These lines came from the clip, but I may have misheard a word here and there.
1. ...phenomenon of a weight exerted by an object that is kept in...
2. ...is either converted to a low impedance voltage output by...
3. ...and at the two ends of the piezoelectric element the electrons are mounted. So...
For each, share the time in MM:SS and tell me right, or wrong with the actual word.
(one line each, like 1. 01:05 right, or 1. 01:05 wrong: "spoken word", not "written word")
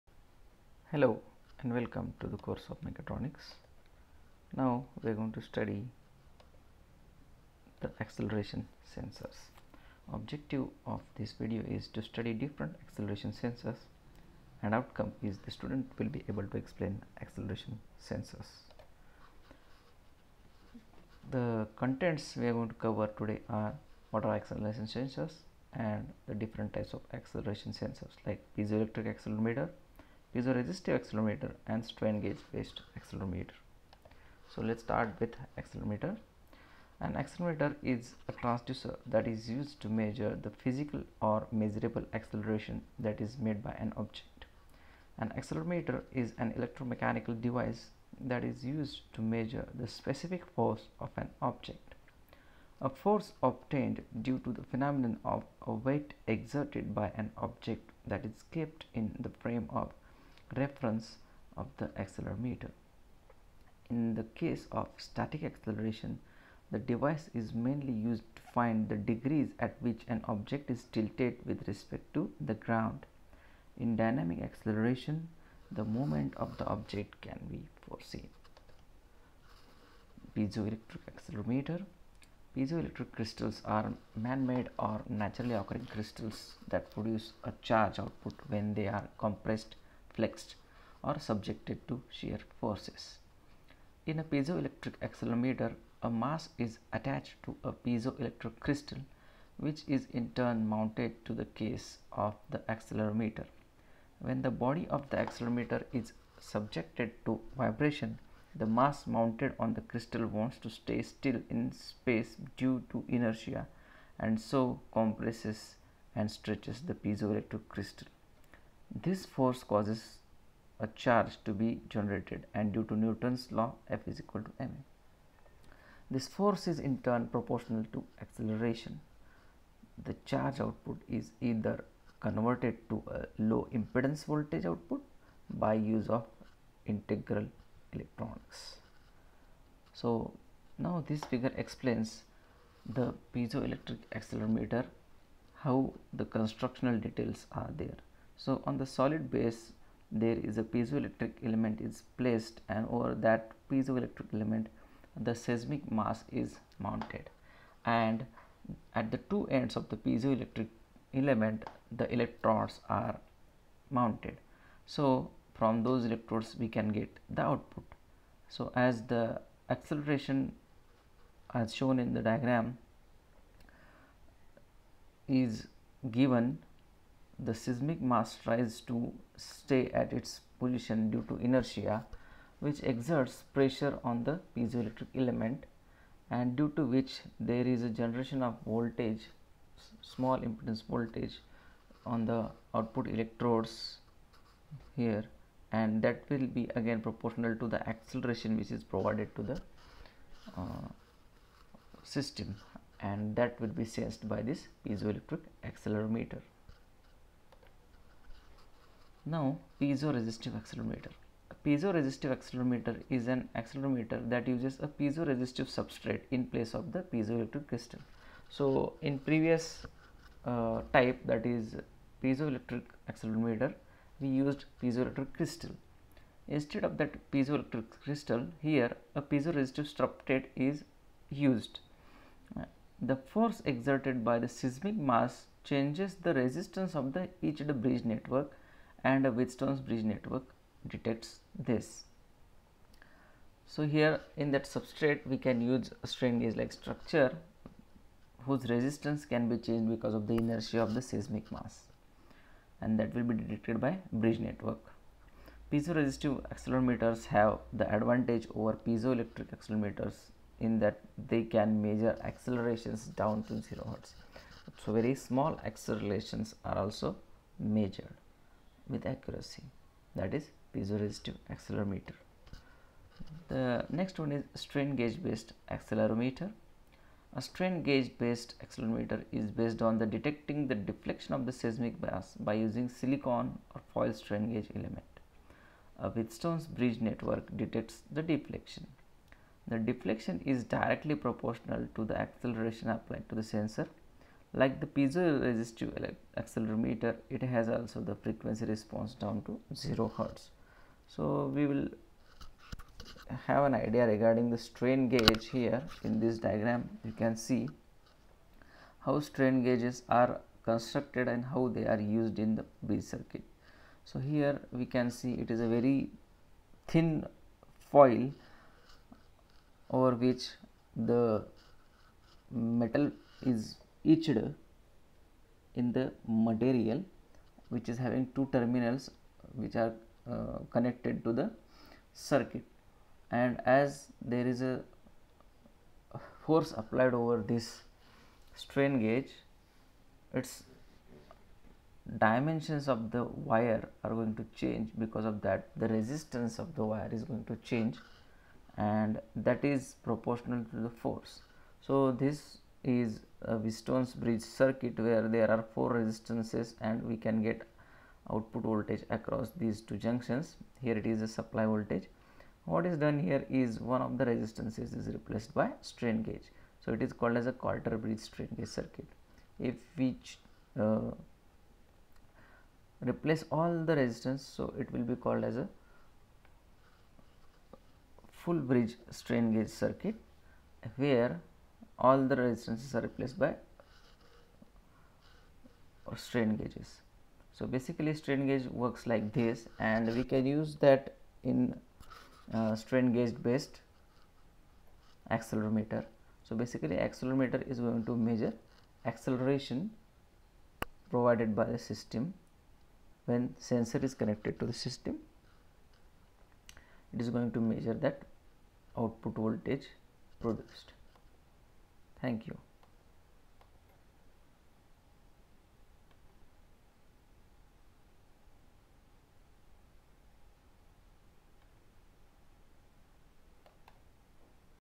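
1. 00:54 right
2. 02:11 right
3. 02:37 right.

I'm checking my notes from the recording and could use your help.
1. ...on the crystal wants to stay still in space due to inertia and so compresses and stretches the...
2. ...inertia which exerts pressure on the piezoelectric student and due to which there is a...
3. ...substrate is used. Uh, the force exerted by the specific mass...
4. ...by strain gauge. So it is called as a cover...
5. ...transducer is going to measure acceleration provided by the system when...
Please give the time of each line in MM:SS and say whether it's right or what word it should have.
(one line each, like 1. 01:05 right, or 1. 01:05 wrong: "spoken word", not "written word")
1. 01:49 right
2. 03:01 wrong: "element", not "student"
3. 03:49 wrong: "seismic", not "specific"
4. 06:05 wrong: "quarter", not "cover"
5. 06:36 wrong: "accelerometer", not "transducer".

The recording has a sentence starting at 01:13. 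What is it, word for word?
In dynamic acceleration, the movement of the object can be foreseen.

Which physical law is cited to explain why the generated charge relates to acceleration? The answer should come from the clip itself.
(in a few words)
Newton's law.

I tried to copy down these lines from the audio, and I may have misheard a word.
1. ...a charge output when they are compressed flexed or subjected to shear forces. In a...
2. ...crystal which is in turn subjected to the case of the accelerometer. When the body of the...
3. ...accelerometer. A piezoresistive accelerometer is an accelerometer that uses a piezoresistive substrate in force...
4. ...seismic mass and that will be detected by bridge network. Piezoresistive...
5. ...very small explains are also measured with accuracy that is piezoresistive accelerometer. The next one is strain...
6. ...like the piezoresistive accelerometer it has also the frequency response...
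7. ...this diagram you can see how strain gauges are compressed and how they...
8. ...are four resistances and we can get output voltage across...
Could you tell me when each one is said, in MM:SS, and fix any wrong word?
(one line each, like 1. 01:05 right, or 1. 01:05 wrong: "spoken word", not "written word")
1. 01:27 right
2. 01:38 wrong: "mounted", not "subjected"
3. 03:30 wrong: "place", not "force"
4. 04:11 right
5. 04:24 wrong: "accelerations", not "explains"
6. 04:54 right
7. 05:06 wrong: "constructed", not "compressed"
8. 05:55 right.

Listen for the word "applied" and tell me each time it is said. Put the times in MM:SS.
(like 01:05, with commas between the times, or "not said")
04:52, 05:36.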